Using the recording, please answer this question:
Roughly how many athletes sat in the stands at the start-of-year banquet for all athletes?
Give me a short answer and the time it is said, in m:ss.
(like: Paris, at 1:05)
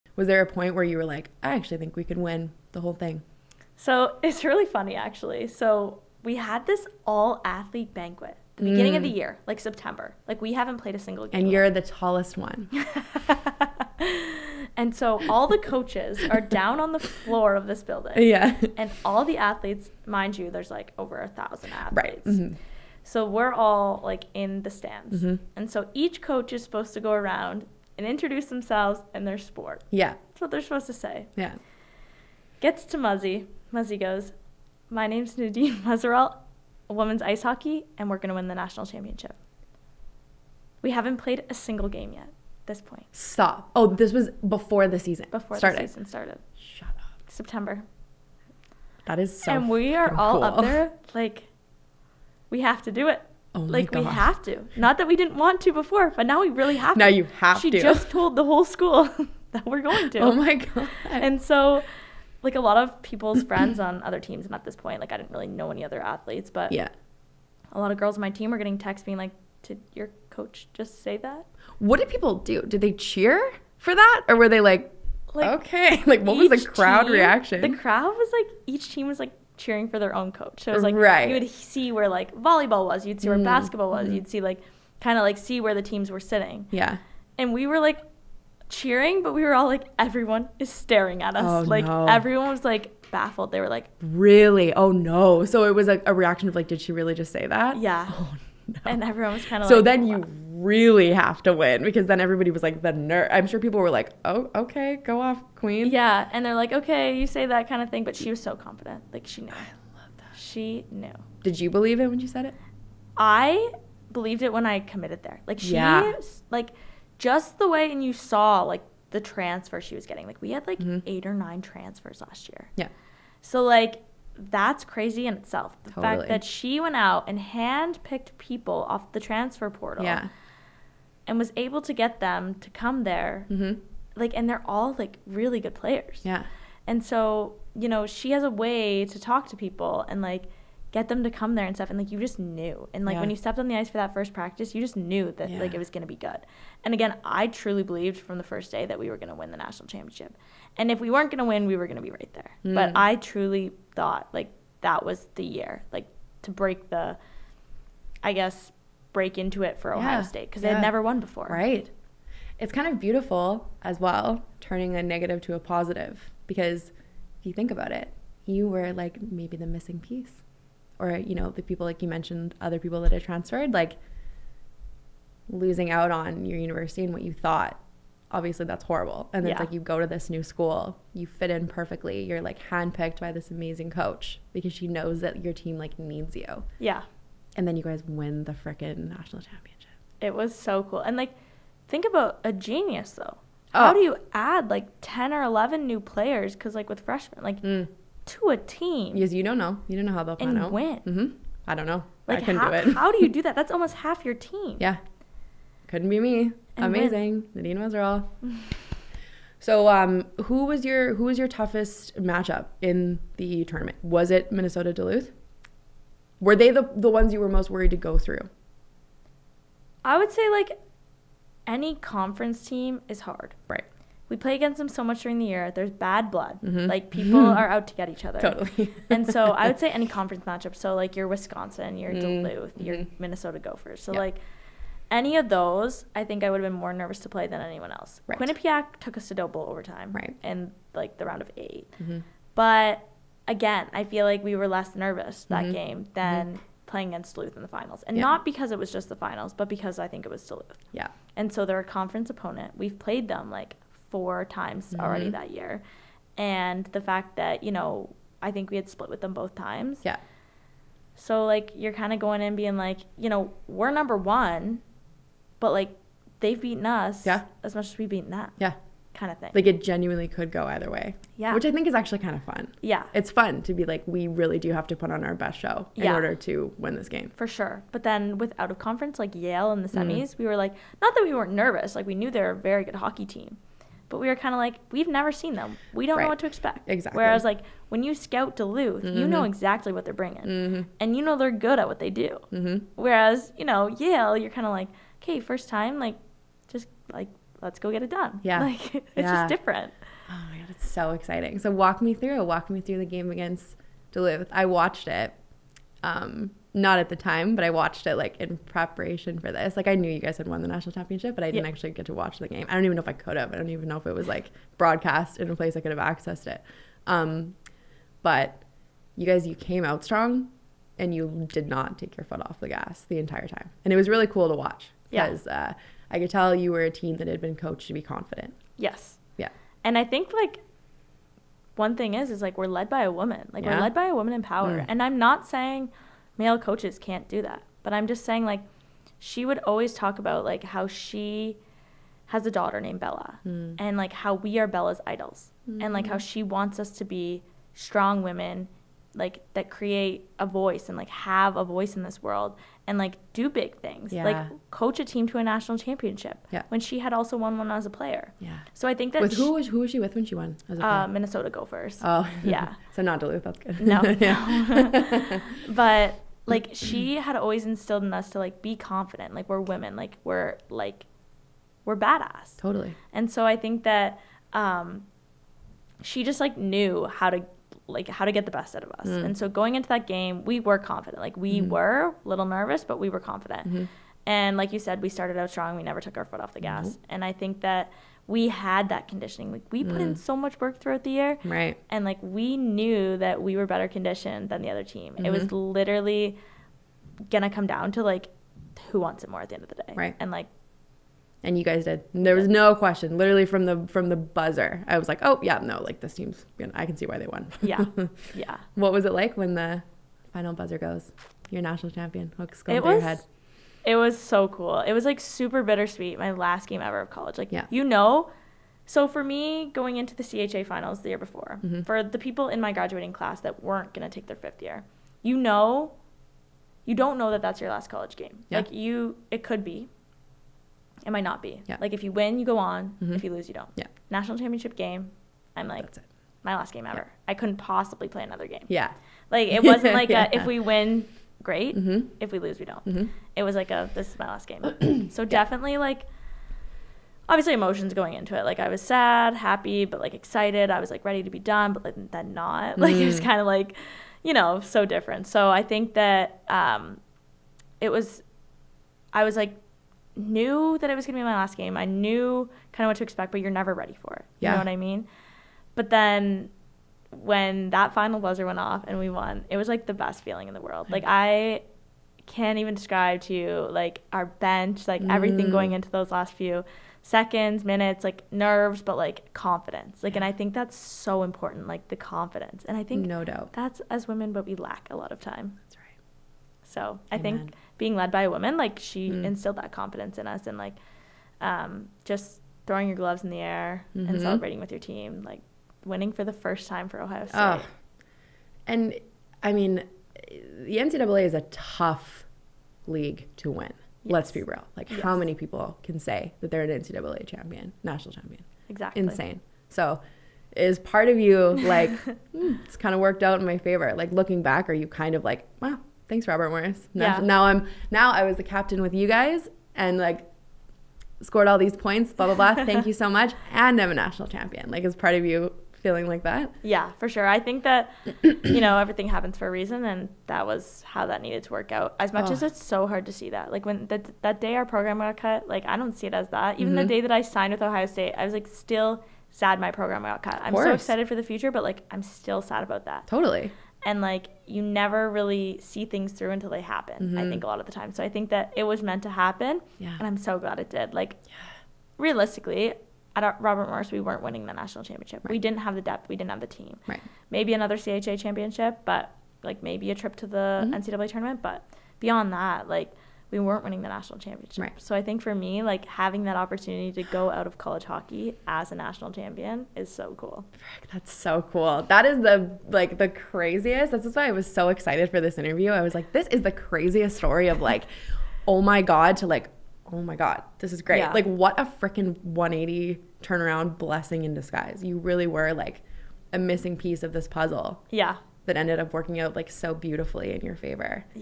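over a thousand, at 0:20.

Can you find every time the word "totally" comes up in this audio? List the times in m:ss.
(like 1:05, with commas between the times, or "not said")
2:05, 3:48, 6:12, 9:03.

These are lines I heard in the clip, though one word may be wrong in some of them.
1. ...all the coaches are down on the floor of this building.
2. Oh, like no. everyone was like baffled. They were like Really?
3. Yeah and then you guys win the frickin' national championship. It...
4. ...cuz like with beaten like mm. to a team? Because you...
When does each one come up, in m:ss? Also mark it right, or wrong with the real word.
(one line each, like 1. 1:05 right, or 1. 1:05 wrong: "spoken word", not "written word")
1. 0:15 right
2. 1:31 right
3. 3:06 right
4. 3:16 wrong: "freshmen", not "beaten".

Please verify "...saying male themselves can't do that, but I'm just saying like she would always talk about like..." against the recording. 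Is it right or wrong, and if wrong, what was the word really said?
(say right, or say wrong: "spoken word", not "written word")
wrong: "coaches", not "themselves".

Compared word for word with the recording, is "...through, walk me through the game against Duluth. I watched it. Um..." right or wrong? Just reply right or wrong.
right.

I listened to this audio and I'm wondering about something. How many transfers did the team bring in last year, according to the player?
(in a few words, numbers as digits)
8 or 9.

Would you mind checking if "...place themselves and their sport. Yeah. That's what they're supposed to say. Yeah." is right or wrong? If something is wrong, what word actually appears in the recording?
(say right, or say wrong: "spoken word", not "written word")
wrong: "introduce", not "place".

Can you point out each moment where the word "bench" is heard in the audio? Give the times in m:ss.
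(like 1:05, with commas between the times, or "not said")
7:54.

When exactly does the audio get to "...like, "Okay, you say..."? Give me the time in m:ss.
1:46.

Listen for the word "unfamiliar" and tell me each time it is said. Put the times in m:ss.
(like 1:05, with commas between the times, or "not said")
not said.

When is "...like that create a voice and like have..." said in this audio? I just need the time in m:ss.
5:49.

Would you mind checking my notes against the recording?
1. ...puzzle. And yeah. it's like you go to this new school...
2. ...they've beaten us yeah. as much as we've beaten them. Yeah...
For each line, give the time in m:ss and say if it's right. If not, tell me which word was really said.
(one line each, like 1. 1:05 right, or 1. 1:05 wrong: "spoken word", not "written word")
1. 2:58 wrong: "horrible", not "puzzle"
2. 4:26 right.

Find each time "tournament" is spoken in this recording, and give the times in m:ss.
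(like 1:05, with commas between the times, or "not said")
3:33, 9:21.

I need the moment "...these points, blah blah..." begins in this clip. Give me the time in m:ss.
8:41.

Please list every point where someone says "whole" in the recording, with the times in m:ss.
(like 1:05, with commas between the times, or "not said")
0:02, 0:58.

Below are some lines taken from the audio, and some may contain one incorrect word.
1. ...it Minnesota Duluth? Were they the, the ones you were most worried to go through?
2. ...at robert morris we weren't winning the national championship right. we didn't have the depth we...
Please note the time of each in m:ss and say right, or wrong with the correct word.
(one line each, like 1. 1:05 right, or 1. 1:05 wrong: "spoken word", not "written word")
1. 3:34 right
2. 9:13 right.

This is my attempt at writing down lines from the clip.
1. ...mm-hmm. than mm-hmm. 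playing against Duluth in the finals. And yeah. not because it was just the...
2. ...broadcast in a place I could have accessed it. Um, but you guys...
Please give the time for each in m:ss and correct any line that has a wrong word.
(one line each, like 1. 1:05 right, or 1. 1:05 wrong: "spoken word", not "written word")
1. 4:06 right
2. 5:14 right.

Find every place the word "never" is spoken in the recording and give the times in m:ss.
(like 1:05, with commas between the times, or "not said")
2:40, 4:45, 6:25, 7:43, 9:04.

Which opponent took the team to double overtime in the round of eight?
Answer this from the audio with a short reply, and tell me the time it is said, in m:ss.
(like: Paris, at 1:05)
Quinnipiac, at 3:58.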